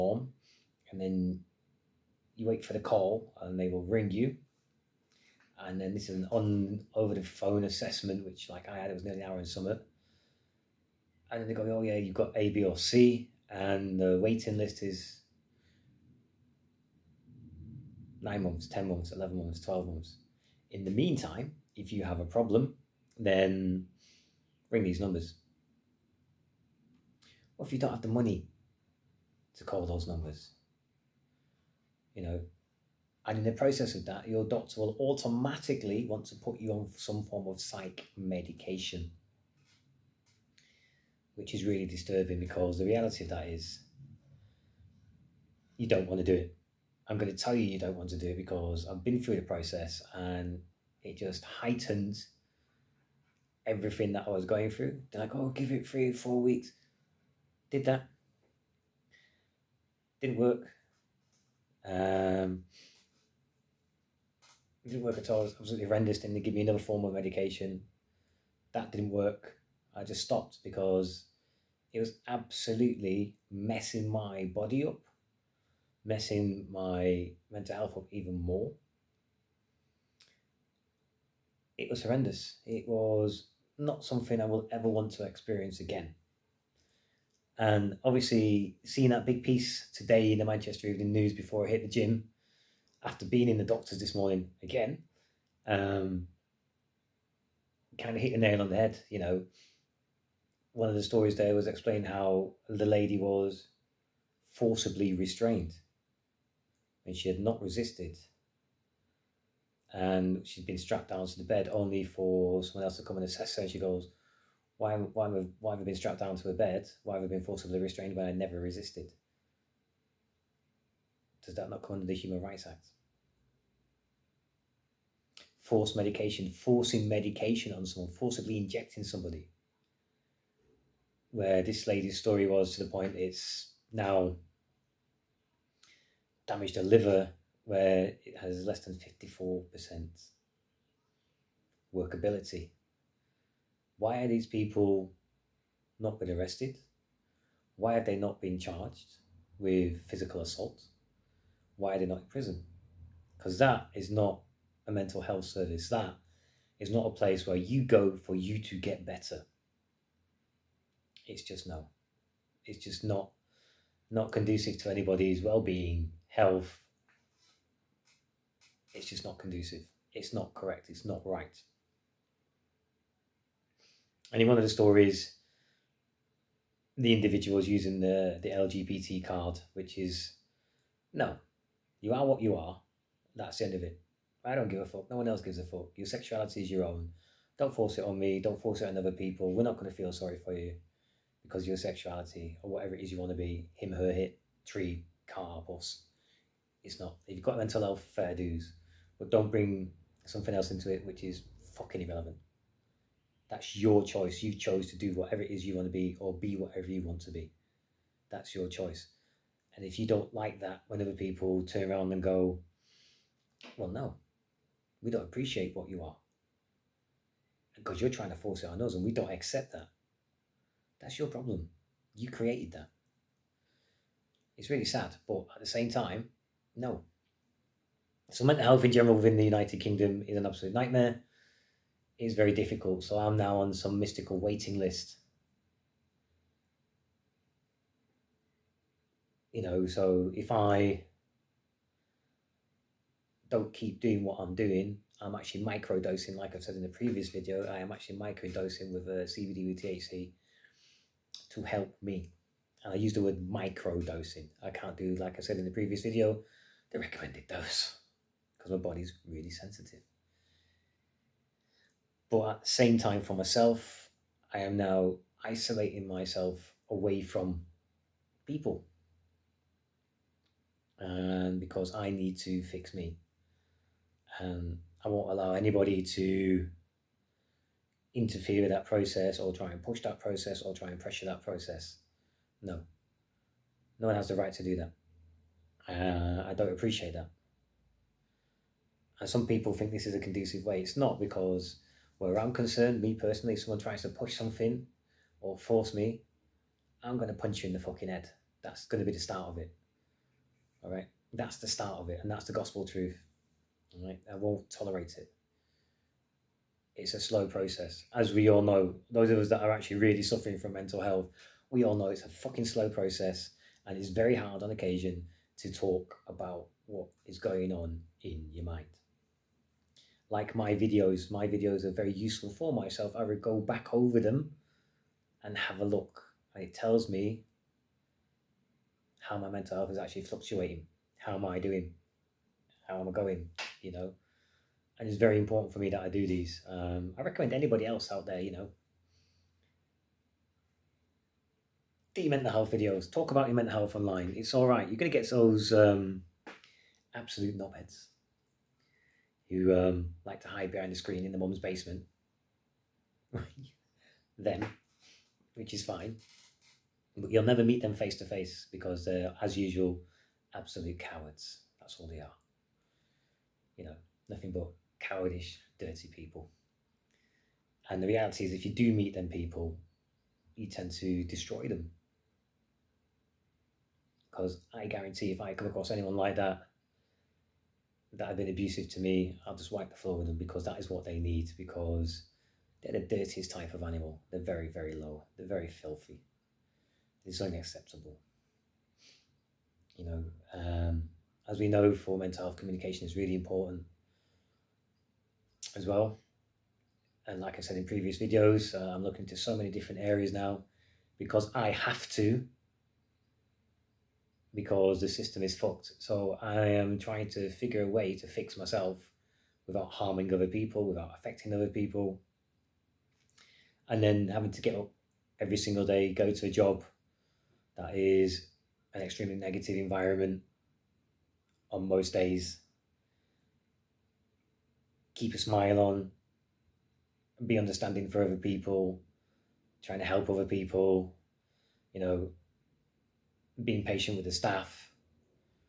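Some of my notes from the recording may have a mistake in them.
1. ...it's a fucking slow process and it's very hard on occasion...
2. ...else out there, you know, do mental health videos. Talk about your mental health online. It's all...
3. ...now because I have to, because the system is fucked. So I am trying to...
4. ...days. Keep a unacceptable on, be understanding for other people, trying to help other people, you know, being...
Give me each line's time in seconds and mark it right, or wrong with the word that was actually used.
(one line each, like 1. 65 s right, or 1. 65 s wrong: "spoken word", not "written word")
1. 312 s right
2. 337 s right
3. 400 s right
4. 422 s wrong: "smile", not "unacceptable".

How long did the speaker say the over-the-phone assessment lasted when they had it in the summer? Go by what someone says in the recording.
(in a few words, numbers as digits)
nearly an hour.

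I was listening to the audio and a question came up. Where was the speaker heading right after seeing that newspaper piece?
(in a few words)
the gym.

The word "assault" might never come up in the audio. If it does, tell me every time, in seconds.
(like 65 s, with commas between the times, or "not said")
150 s.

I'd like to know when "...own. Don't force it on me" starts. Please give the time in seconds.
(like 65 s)
186 s.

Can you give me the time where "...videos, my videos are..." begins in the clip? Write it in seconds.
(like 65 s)
320 s.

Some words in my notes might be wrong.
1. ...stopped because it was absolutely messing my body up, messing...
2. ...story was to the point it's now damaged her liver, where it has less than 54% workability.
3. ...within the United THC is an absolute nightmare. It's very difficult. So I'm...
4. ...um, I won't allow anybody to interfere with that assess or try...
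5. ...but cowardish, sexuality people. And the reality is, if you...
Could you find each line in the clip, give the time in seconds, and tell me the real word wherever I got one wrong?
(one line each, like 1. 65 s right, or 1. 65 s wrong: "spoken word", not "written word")
1. 70 s right
2. 132 s right
3. 229 s wrong: "Kingdom", not "THC"
4. 274 s wrong: "process", not "assess"
5. 364 s wrong: "dirty", not "sexuality".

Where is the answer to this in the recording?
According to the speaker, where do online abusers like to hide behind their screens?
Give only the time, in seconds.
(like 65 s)
351 s.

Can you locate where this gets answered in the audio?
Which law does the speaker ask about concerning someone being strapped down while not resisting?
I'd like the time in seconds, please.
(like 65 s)
122 s.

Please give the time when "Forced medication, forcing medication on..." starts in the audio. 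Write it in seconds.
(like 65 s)
125 s.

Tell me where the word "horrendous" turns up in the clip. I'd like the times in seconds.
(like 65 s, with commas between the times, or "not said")
65 s, 82 s.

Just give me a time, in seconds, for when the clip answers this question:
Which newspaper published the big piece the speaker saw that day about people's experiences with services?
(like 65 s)
90 s.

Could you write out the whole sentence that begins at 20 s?
In the meantime, if you have a problem, then ring these numbers.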